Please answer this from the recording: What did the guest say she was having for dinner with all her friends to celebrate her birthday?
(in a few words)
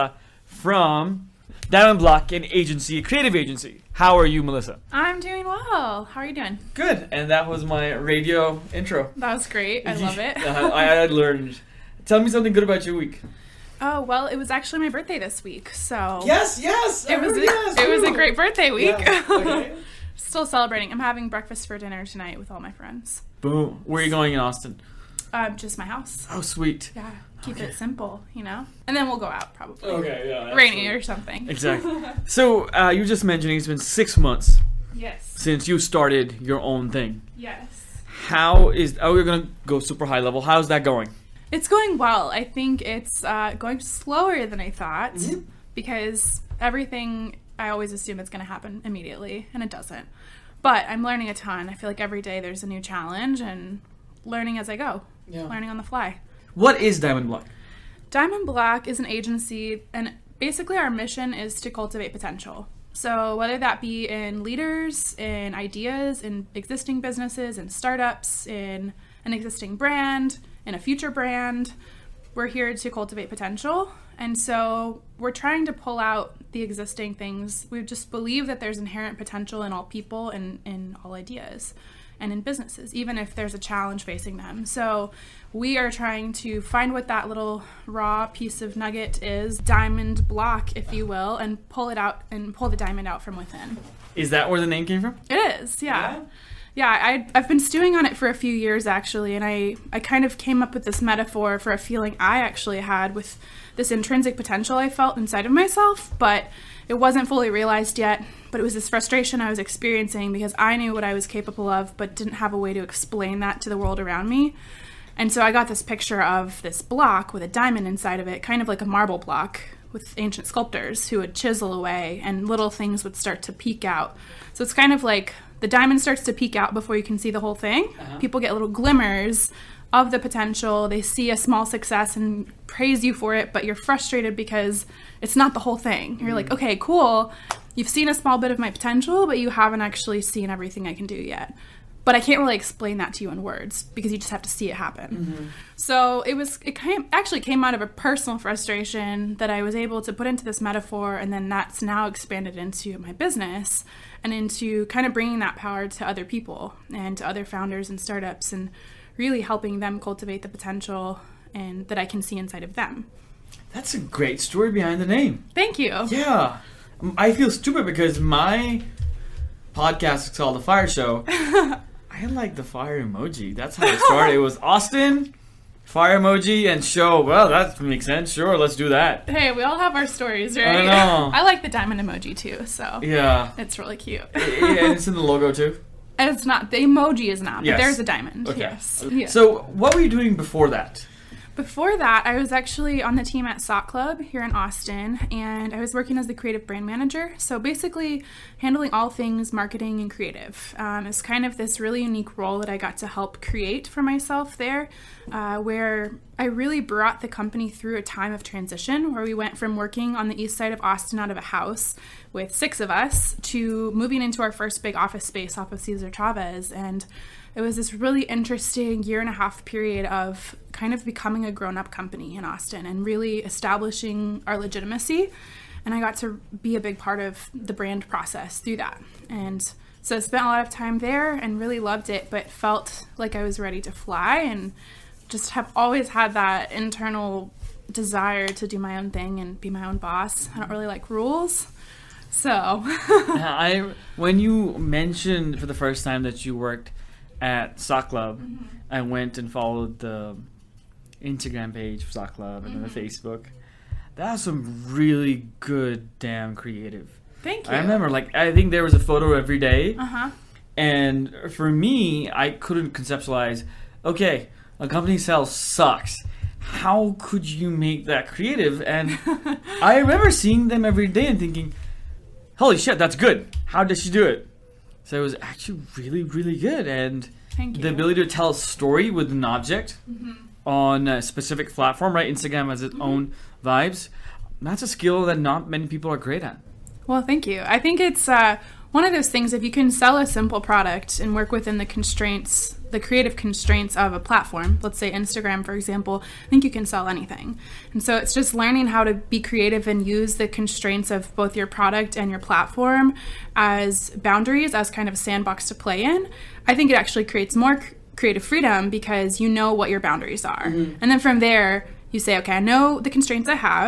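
Breakfast.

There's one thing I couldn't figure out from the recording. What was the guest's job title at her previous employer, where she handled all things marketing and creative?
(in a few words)
Creative brand manager.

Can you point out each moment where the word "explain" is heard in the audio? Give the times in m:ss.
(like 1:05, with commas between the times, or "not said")
1:52, 2:22.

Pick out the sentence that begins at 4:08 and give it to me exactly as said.
I went and followed the Instagram page for Sock Club and mm-hmm.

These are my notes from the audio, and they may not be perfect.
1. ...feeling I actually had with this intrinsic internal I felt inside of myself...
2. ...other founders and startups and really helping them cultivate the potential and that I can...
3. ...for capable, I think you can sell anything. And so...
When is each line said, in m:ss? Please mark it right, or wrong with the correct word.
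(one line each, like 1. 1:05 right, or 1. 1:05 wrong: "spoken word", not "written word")
1. 1:41 wrong: "potential", not "internal"
2. 2:37 right
3. 4:55 wrong: "example", not "capable".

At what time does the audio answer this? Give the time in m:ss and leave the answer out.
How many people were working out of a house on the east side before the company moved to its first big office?
3:32.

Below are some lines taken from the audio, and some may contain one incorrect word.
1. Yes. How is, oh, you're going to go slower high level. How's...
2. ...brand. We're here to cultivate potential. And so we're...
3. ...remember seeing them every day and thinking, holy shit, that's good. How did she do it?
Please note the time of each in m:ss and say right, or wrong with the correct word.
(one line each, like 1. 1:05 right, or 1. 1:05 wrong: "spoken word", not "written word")
1. 0:37 wrong: "super", not "slower"
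2. 1:11 right
3. 4:29 right.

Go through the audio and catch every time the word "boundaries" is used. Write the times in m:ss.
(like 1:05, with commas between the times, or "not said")
5:04, 5:09.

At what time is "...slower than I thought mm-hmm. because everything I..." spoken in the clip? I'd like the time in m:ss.
0:43.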